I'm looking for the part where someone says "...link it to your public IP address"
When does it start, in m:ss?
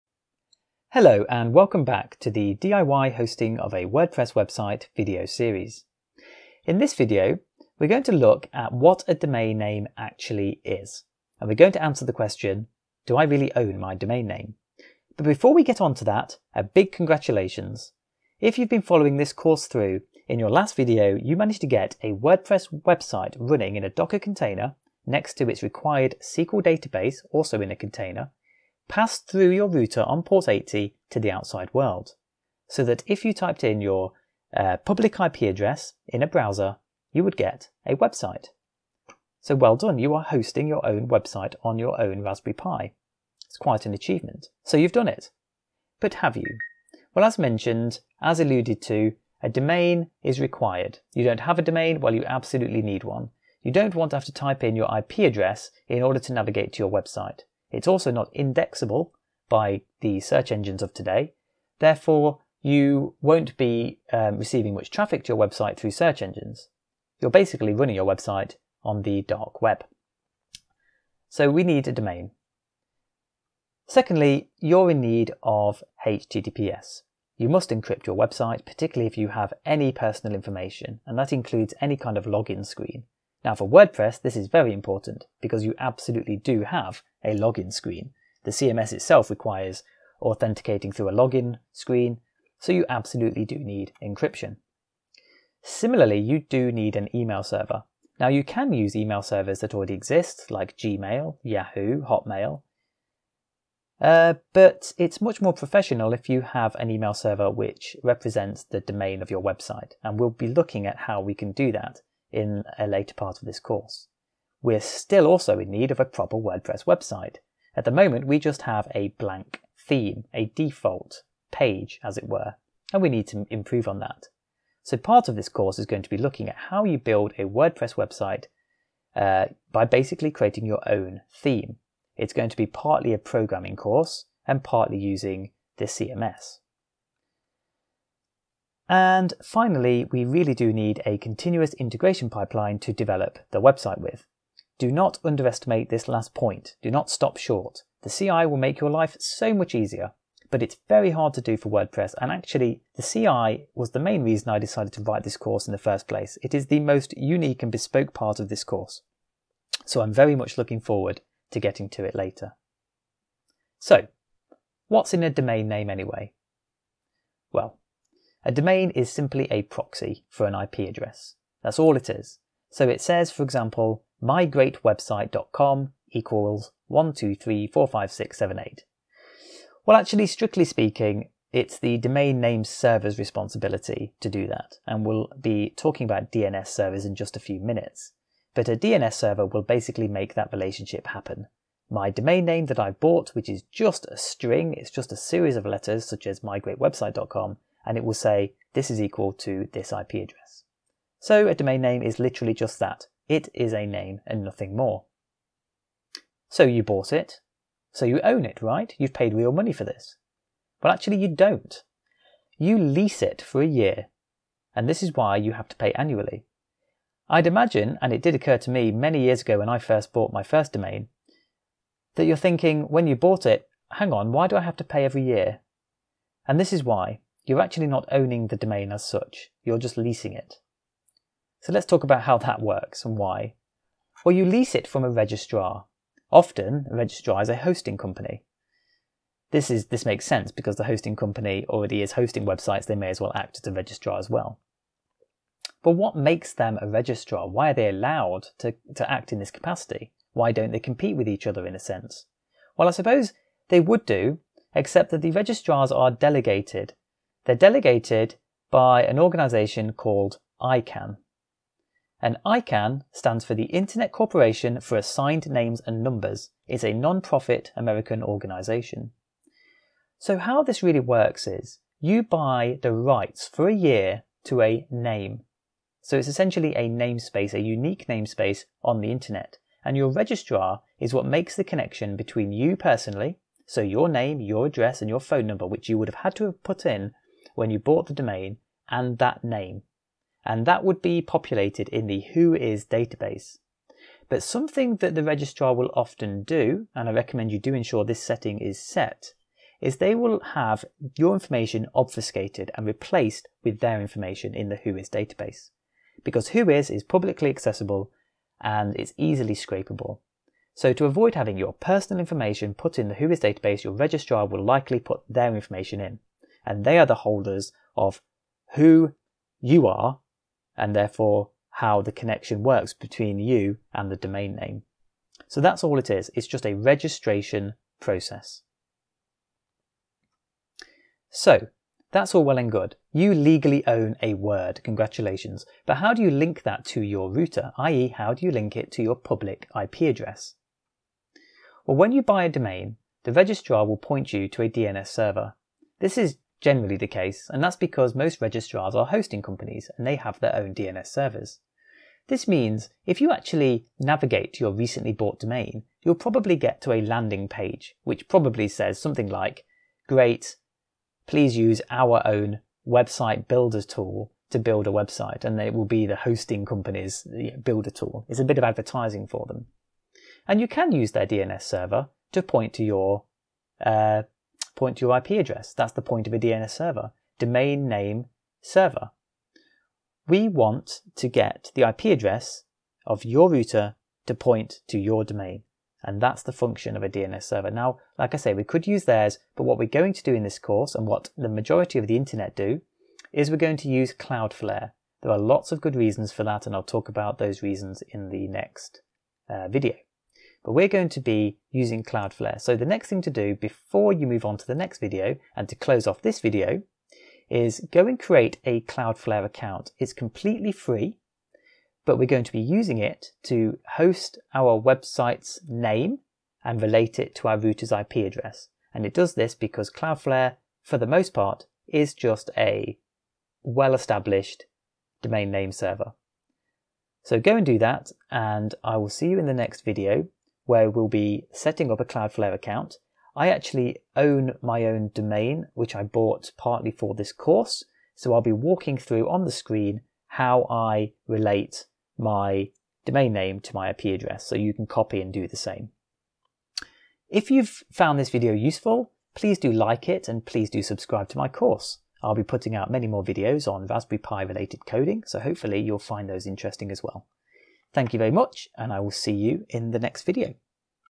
5:38.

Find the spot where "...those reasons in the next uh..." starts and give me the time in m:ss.
6:37.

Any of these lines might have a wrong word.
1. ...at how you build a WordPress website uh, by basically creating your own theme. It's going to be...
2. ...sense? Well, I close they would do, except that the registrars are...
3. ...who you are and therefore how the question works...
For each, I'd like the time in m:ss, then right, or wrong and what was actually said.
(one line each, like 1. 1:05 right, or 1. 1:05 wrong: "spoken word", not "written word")
1. 2:06 right
2. 4:11 wrong: "suppose", not "close"
3. 5:18 wrong: "connection", not "question".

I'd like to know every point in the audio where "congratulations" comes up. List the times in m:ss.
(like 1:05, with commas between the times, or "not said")
0:16, 5:34.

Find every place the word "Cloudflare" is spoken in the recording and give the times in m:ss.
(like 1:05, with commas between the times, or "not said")
6:34, 6:42, 6:48, 6:59, 7:12.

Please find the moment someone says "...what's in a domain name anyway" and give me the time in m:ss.
2:44.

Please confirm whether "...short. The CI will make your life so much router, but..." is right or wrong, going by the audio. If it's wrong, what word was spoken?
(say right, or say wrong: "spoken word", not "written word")
wrong: "easier", not "router".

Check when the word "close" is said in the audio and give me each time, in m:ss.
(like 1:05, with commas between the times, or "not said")
6:45.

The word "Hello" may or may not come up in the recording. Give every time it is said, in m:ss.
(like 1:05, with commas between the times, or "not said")
0:00.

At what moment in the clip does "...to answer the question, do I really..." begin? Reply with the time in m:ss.
0:11.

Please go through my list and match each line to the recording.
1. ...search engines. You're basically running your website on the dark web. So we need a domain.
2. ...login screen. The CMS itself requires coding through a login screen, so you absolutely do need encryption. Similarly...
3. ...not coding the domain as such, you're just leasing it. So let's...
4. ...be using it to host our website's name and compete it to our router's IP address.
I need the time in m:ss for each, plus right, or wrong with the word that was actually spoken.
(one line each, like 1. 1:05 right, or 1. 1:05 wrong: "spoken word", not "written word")
1. 1:05 right
2. 1:27 wrong: "authenticating", not "coding"
3. 3:47 wrong: "owning", not "coding"
4. 6:52 wrong: "relate", not "compete".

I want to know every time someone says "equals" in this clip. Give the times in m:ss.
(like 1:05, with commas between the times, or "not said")
2:56, 3:19.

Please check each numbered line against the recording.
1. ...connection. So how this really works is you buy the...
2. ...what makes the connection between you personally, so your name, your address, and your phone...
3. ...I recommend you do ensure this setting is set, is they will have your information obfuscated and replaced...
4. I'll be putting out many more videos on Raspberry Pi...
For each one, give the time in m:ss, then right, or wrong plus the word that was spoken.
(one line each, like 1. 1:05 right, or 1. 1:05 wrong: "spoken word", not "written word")
1. 4:28 wrong: "organization", not "connection"
2. 4:41 right
3. 4:57 right
4. 7:32 right.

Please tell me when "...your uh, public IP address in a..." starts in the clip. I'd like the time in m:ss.
0:33.